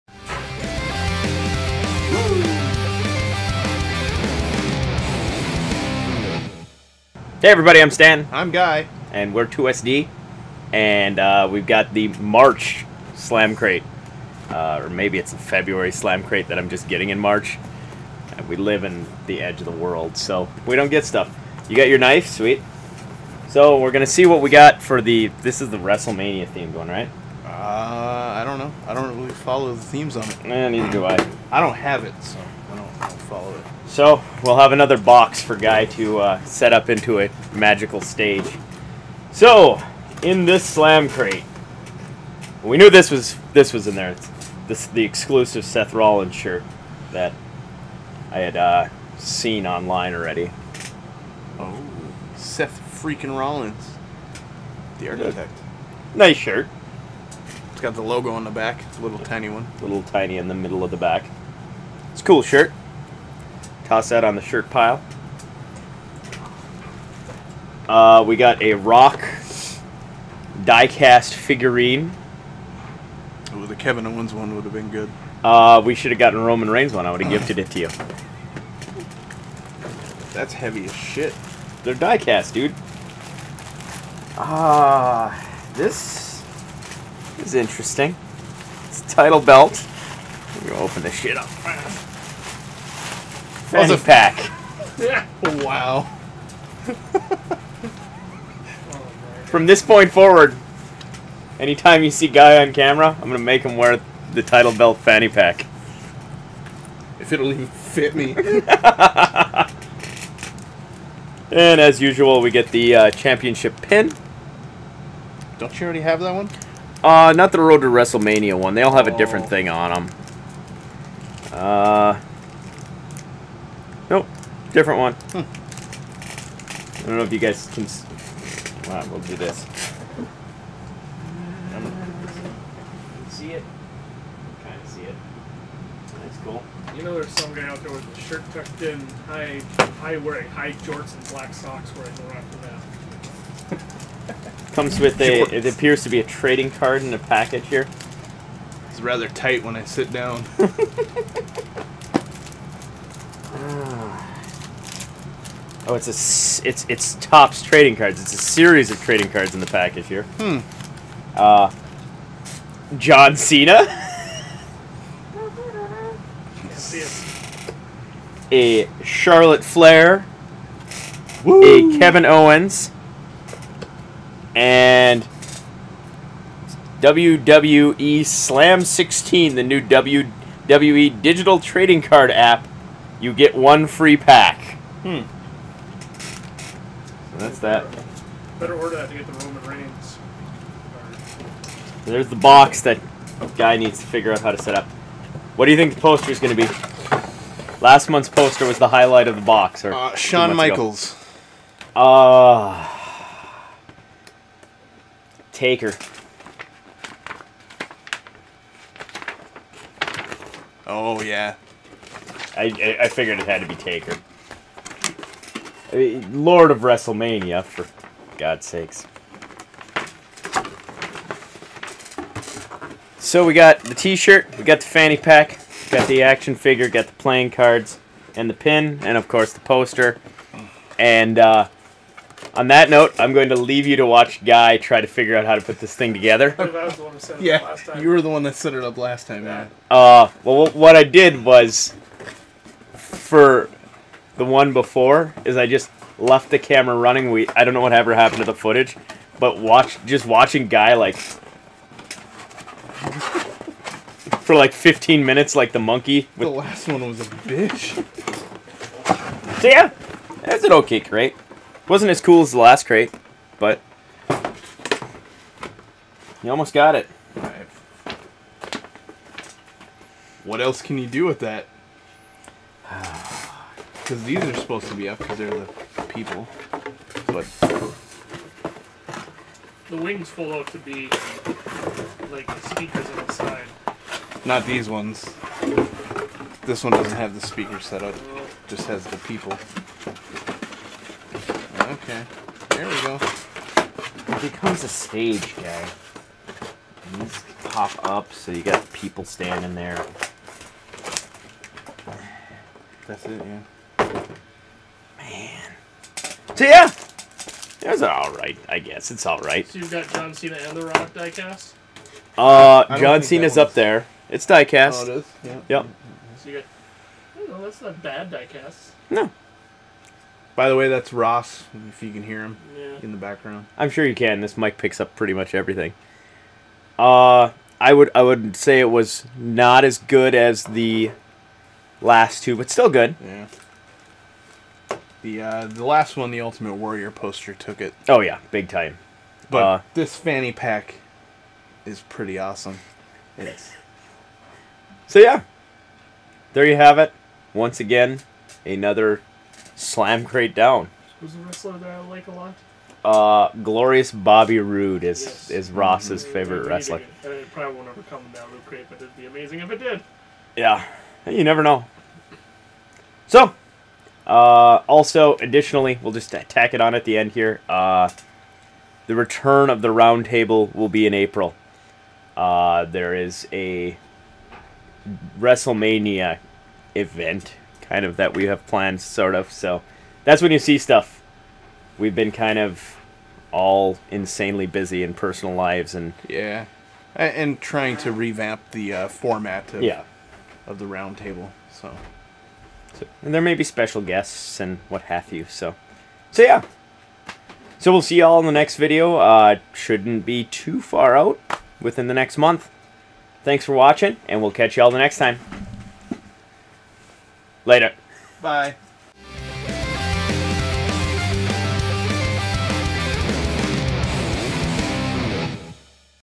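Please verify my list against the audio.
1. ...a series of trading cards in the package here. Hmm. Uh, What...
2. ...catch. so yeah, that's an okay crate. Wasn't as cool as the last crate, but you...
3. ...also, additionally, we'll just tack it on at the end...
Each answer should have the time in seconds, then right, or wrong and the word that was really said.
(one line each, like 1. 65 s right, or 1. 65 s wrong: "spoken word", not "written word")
1. 158 s wrong: "John", not "What"
2. 257 s wrong: "bitch", not "catch"
3. 364 s right.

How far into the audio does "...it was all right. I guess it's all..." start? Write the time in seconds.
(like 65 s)
307 s.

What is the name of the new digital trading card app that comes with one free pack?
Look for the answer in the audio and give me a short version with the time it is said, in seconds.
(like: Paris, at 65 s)
WWE Slam 16, at 177 s.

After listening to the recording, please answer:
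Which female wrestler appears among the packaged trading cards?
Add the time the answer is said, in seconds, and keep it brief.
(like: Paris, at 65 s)
Charlotte Flair, at 169 s.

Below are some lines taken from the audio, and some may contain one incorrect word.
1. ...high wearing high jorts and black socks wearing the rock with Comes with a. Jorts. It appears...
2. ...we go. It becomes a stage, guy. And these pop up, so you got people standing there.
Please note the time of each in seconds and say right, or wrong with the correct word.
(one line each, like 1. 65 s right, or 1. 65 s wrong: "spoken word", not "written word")
1. 139 s right
2. 292 s right.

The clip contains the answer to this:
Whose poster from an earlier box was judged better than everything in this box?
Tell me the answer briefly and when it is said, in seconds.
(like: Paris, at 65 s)
Ultimate Warrior, at 336 s.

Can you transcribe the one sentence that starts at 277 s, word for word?
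But the wings fall out to be like speakers on the side.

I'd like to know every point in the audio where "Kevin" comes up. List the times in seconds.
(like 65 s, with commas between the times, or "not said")
73 s, 171 s.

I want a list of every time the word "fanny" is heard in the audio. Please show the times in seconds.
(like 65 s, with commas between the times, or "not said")
93 s, 104 s, 224 s, 340 s.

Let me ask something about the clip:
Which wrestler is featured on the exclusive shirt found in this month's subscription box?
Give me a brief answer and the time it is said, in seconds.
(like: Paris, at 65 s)
Seth Rollins, at 45 s.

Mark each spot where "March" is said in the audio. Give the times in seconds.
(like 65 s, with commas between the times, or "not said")
12 s, 17 s.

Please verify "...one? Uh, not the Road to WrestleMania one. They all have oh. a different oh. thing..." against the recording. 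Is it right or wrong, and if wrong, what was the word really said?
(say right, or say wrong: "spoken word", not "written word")
right.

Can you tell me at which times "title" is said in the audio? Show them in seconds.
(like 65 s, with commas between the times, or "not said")
89 s, 104 s.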